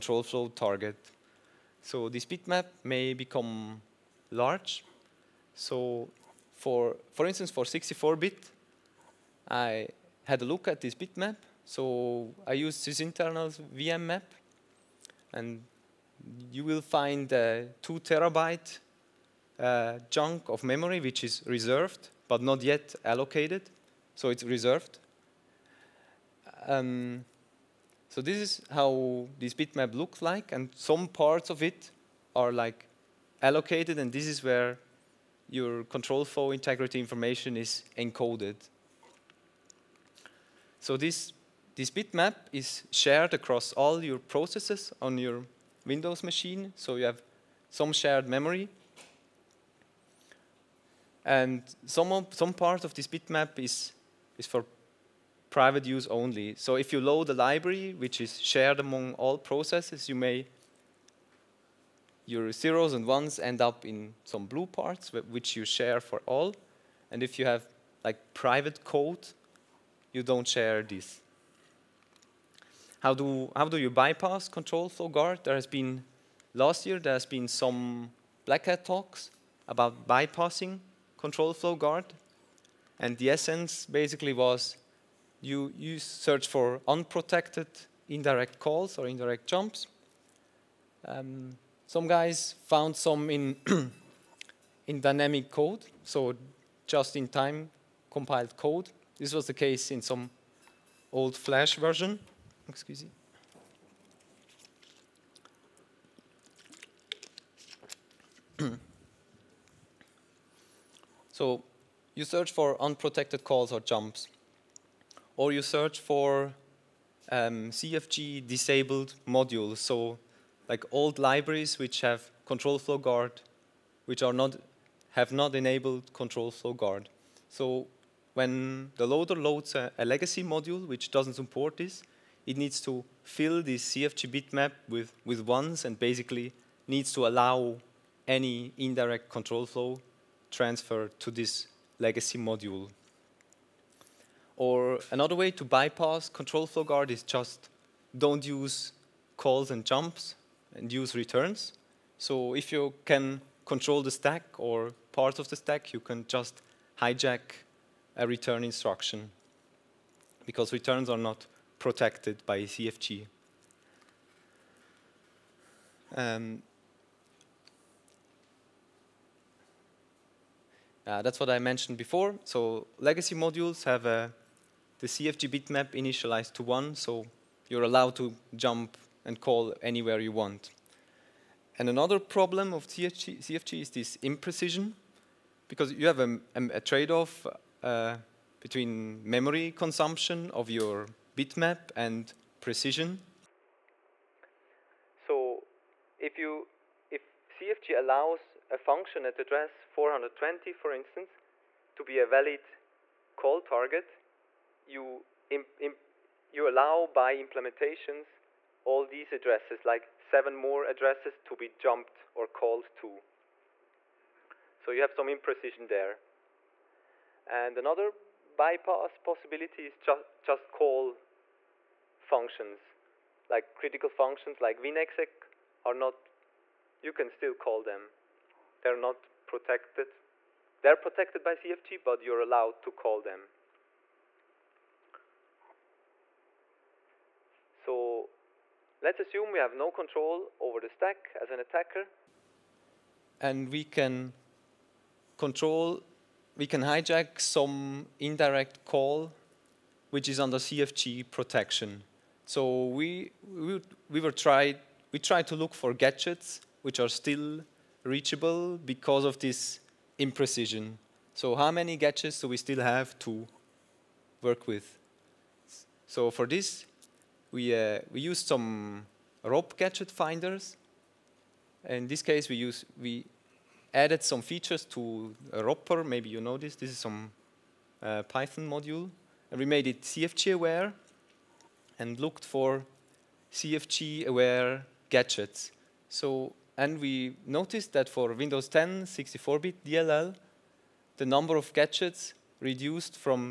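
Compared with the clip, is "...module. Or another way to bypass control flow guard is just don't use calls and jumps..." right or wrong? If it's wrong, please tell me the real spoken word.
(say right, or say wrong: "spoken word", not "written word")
right.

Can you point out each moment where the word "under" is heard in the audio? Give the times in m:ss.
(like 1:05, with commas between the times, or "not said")
4:10.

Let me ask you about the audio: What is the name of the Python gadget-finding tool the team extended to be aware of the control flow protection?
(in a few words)
Ropper.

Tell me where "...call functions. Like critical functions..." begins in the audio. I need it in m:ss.
3:40.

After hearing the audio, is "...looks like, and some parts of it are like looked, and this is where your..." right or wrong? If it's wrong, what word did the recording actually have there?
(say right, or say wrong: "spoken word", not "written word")
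wrong: "allocated", not "looked".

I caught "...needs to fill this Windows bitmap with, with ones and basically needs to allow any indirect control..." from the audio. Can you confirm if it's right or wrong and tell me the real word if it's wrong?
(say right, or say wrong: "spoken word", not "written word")
wrong: "CFG", not "Windows".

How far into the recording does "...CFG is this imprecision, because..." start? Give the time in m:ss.
3:03.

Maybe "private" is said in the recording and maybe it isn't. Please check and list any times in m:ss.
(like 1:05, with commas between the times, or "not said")
0:55, 1:08.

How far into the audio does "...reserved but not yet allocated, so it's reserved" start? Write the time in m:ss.
0:21.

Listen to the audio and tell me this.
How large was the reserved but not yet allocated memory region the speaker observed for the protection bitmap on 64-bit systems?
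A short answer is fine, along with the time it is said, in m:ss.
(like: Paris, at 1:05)
2 terabytes, at 0:17.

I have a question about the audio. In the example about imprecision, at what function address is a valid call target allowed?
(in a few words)
420.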